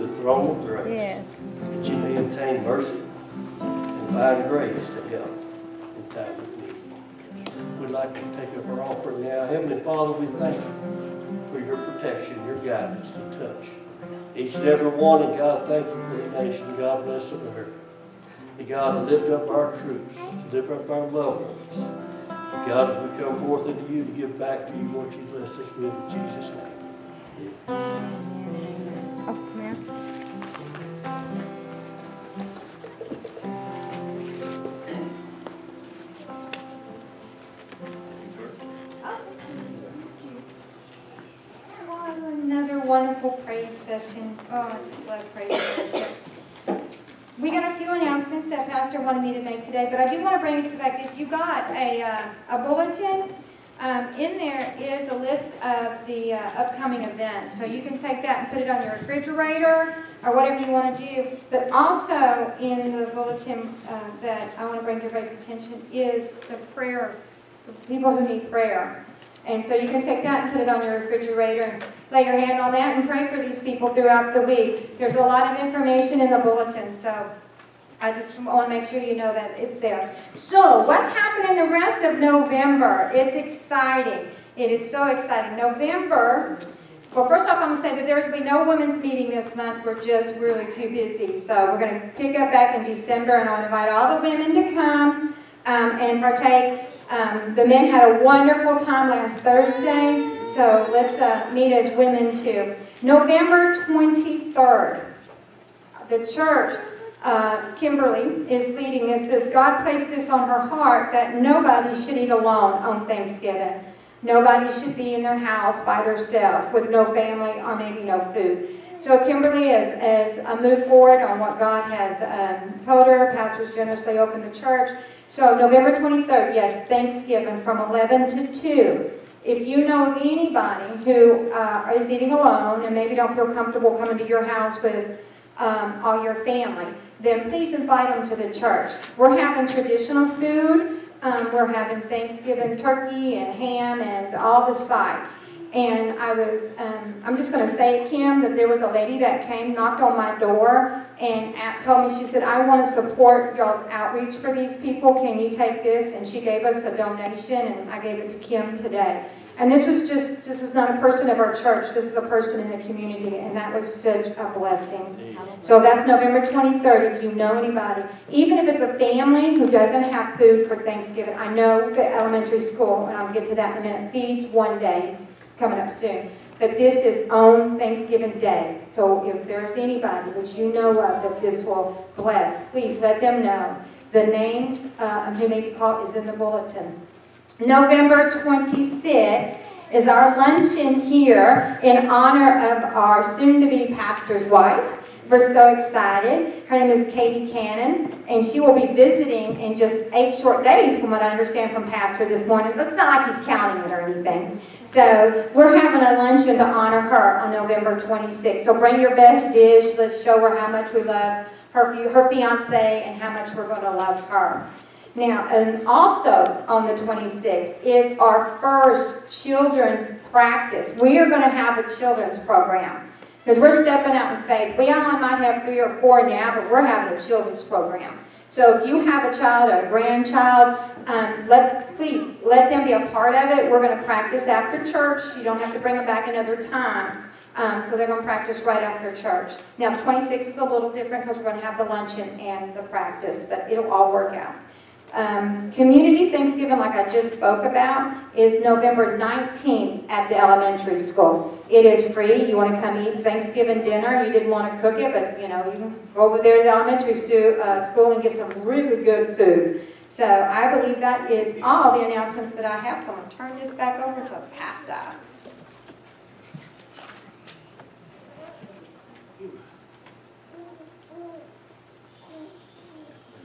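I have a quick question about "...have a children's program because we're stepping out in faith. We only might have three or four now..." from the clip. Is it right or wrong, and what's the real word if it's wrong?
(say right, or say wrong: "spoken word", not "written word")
right.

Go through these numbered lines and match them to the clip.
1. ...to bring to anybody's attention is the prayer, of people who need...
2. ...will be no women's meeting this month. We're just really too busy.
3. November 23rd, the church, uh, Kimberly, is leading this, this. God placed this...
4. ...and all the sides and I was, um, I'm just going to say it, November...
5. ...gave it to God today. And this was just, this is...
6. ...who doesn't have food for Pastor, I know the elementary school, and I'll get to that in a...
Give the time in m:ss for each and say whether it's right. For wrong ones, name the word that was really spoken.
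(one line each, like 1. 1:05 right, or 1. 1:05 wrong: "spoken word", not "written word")
1. 1:04 wrong: "everybody", not "anybody"
2. 1:28 right
3. 1:43 right
4. 2:24 wrong: "Kim", not "November"
5. 2:38 wrong: "Kim", not "God"
6. 2:49 wrong: "Thanksgiving", not "Pastor".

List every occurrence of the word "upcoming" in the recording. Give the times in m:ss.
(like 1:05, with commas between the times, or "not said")
0:56.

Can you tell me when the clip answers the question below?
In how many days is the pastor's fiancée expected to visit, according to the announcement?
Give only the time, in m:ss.
3:20.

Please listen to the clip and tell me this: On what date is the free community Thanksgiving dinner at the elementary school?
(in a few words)
November 19th.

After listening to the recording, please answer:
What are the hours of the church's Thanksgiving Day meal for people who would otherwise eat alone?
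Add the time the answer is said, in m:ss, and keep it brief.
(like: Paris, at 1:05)
11 to 2, at 2:07.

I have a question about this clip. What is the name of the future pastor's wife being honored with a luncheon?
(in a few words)
Katie Cannon.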